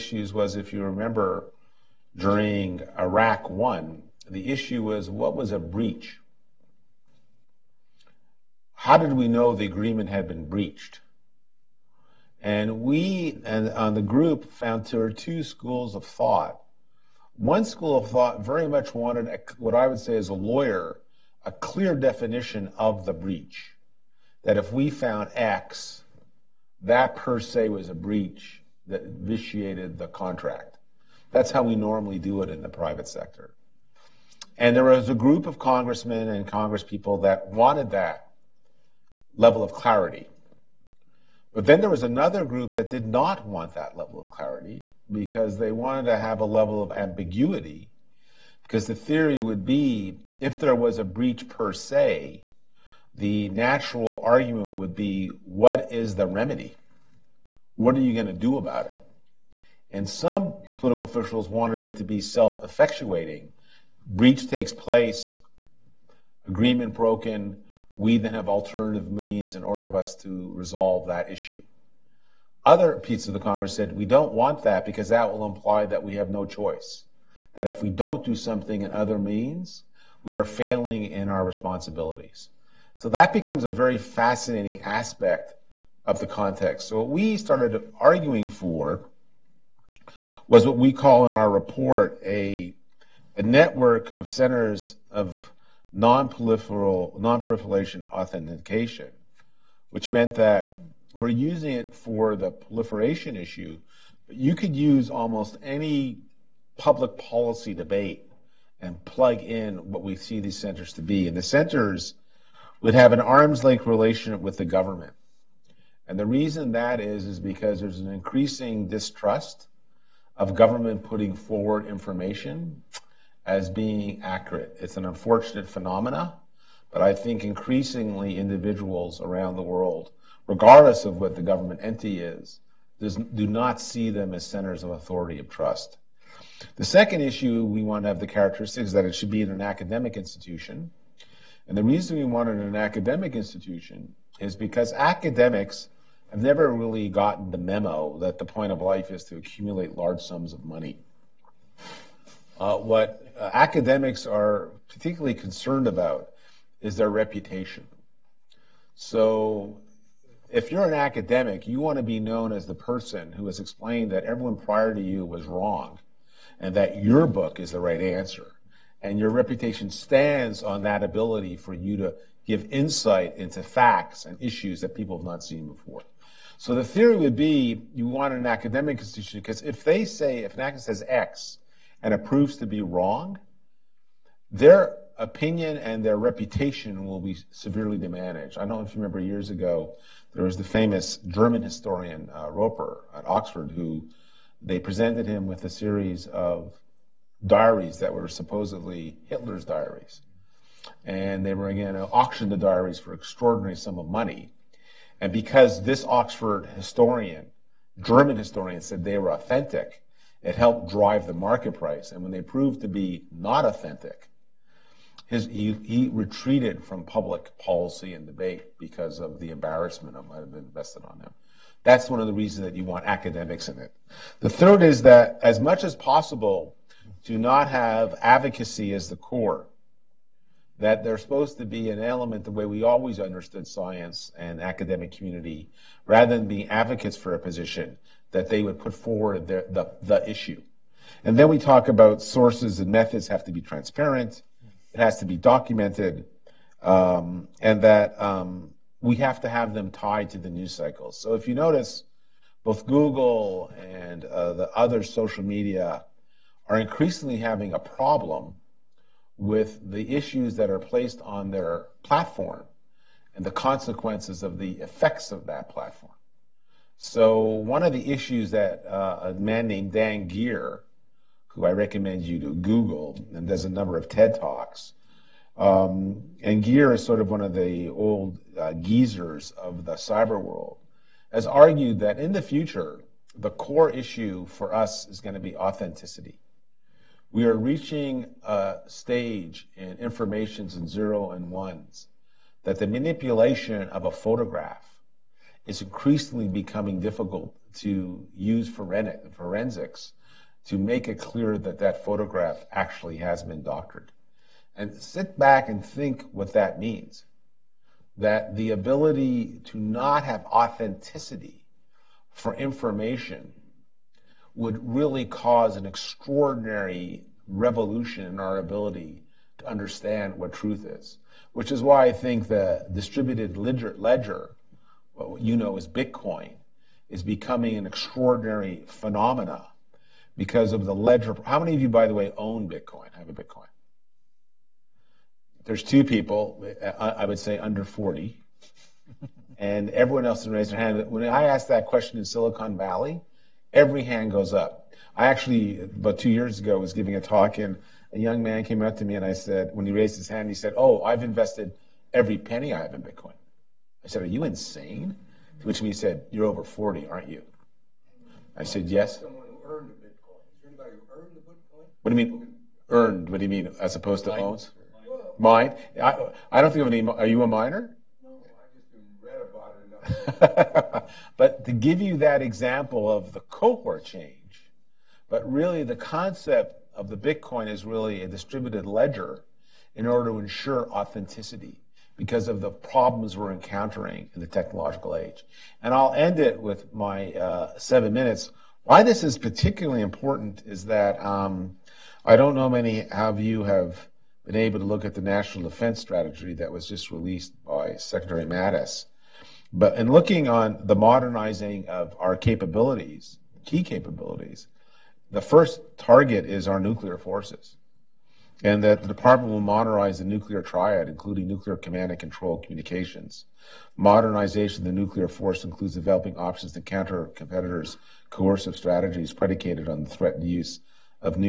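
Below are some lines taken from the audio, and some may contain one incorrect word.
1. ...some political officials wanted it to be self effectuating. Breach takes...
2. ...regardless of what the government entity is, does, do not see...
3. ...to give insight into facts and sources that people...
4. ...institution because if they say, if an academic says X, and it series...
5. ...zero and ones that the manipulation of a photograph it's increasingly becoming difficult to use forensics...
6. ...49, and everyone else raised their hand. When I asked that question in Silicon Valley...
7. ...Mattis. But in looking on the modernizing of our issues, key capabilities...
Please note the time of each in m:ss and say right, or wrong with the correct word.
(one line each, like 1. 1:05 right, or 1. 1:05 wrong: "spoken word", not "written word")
1. 1:00 right
2. 2:10 right
3. 2:51 wrong: "issues", not "sources"
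4. 2:58 wrong: "proves", not "series"
5. 4:50 right
6. 5:37 wrong: "40", not "49"
7. 6:38 wrong: "capabilities", not "issues".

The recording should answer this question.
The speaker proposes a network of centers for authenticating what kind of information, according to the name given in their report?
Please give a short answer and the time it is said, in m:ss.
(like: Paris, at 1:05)
Non proliferation authentication, at 1:35.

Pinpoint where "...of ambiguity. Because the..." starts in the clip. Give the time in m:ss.
0:46.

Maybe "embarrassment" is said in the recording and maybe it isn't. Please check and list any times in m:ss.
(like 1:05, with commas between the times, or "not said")
3:39.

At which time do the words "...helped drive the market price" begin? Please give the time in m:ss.
3:30.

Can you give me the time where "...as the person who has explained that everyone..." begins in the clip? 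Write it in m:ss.
2:42.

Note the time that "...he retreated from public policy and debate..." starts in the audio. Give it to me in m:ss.
3:35.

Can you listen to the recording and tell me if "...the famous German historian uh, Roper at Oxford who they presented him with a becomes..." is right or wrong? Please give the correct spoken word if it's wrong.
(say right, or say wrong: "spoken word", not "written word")
wrong: "series", not "becomes".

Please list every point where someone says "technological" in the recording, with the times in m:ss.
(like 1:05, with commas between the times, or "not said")
6:24.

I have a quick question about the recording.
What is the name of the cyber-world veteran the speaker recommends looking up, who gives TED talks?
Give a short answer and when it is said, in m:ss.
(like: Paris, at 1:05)
Dan Geer, at 4:29.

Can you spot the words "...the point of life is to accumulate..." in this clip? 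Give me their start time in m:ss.
2:28.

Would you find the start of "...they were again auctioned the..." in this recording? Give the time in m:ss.
3:21.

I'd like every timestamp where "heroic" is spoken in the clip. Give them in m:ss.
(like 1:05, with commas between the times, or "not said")
not said.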